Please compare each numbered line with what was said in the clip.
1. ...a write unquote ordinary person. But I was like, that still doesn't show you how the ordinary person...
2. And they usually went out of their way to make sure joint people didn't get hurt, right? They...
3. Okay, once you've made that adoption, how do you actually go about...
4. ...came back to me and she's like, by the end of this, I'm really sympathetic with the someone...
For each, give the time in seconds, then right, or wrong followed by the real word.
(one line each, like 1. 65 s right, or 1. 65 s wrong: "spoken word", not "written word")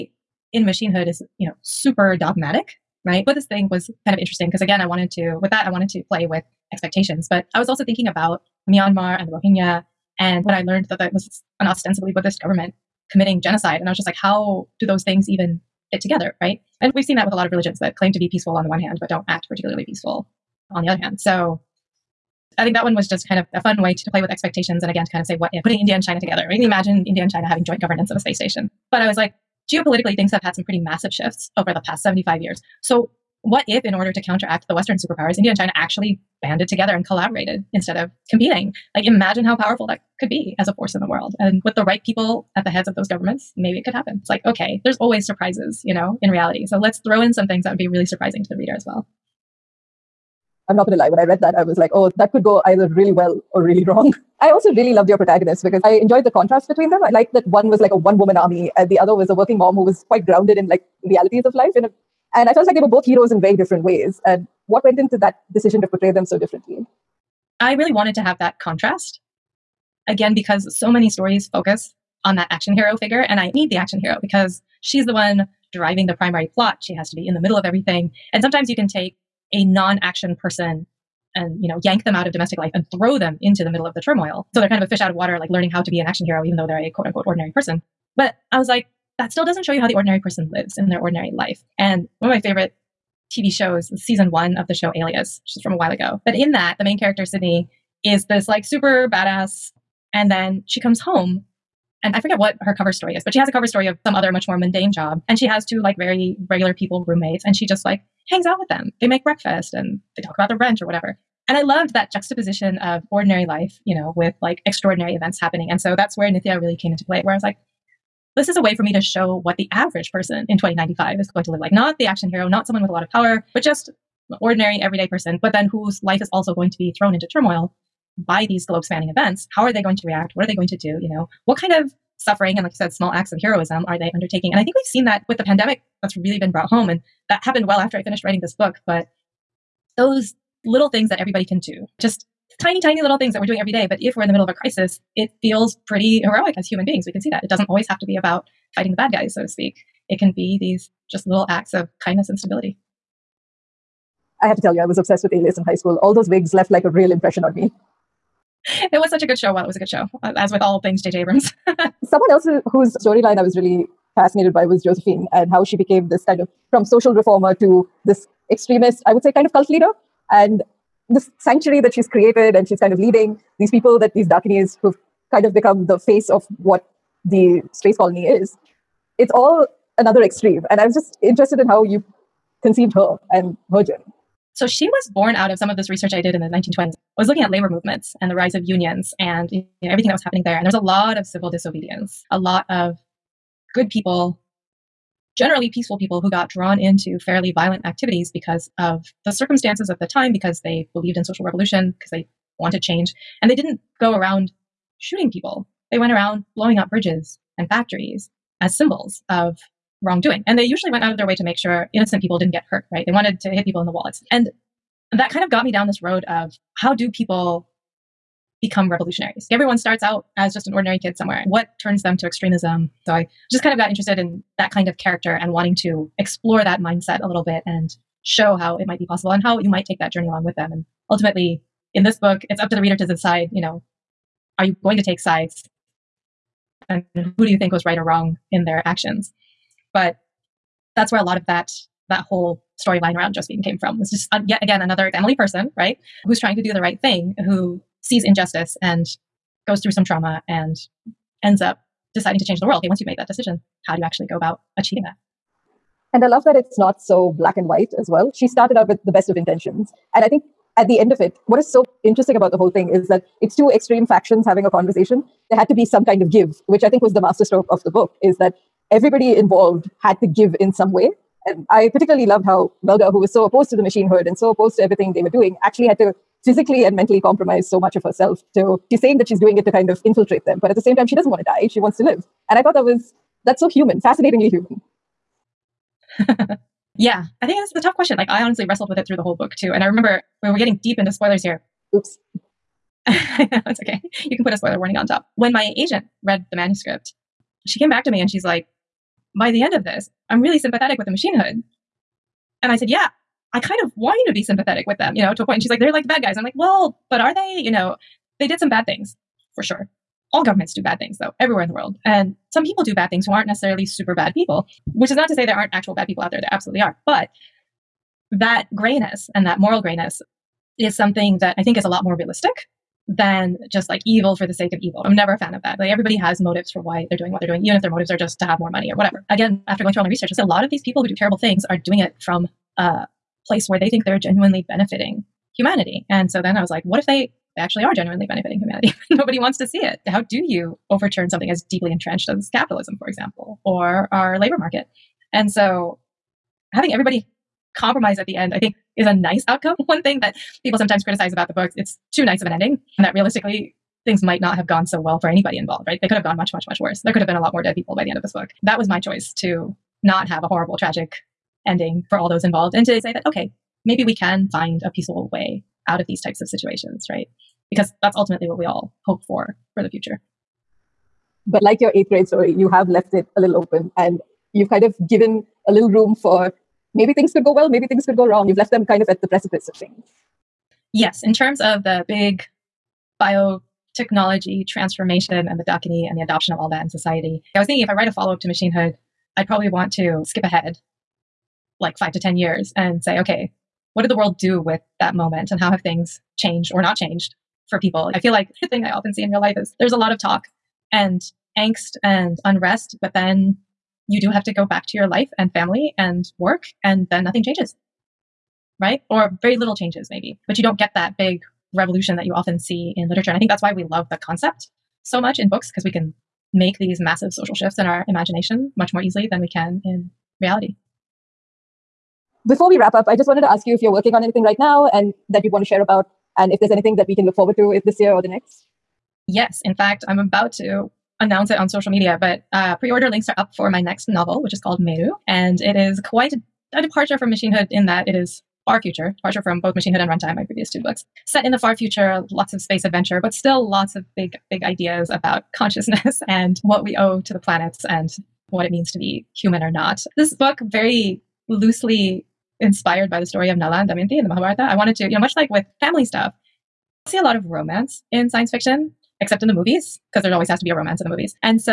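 1. 86 s wrong: "quote", not "write"
2. 210 s wrong: "innocent", not "joint"
3. 252 s wrong: "decision", not "adoption"
4. 297 s wrong: "machine", not "someone".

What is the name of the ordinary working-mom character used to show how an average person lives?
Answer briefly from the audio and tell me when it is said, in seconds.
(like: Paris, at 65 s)
Nithya, at 116 s.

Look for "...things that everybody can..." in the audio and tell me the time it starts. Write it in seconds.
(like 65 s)
140 s.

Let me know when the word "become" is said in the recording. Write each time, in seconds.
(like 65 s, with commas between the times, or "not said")
175 s, 218 s.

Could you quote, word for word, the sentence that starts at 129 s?
How are they going to react?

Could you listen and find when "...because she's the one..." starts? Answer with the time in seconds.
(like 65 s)
74 s.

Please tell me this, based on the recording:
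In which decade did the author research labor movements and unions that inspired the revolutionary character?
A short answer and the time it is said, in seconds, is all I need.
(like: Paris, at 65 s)
1920s, at 186 s.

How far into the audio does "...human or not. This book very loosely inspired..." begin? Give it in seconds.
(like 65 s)
449 s.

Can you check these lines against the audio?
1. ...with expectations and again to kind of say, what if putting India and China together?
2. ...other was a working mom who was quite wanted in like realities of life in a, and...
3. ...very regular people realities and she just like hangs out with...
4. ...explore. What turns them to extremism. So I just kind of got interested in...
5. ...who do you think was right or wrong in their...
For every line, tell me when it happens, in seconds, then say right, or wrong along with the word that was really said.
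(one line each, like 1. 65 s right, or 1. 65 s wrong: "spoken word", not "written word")
1. 24 s right
2. 58 s wrong: "grounded", not "wanted"
3. 105 s wrong: "roommates", not "realities"
4. 221 s wrong: "somewhere", not "explore"
5. 237 s right.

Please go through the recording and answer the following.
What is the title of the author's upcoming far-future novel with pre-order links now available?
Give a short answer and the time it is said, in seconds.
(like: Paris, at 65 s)
Meru, at 434 s.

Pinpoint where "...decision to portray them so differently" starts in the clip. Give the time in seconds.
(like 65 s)
65 s.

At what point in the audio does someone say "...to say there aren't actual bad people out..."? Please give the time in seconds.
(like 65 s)
315 s.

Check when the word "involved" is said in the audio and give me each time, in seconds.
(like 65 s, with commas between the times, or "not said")
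269 s, 355 s, 362 s.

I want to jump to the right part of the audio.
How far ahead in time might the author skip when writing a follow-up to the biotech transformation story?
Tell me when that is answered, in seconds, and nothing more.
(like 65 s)
391 s.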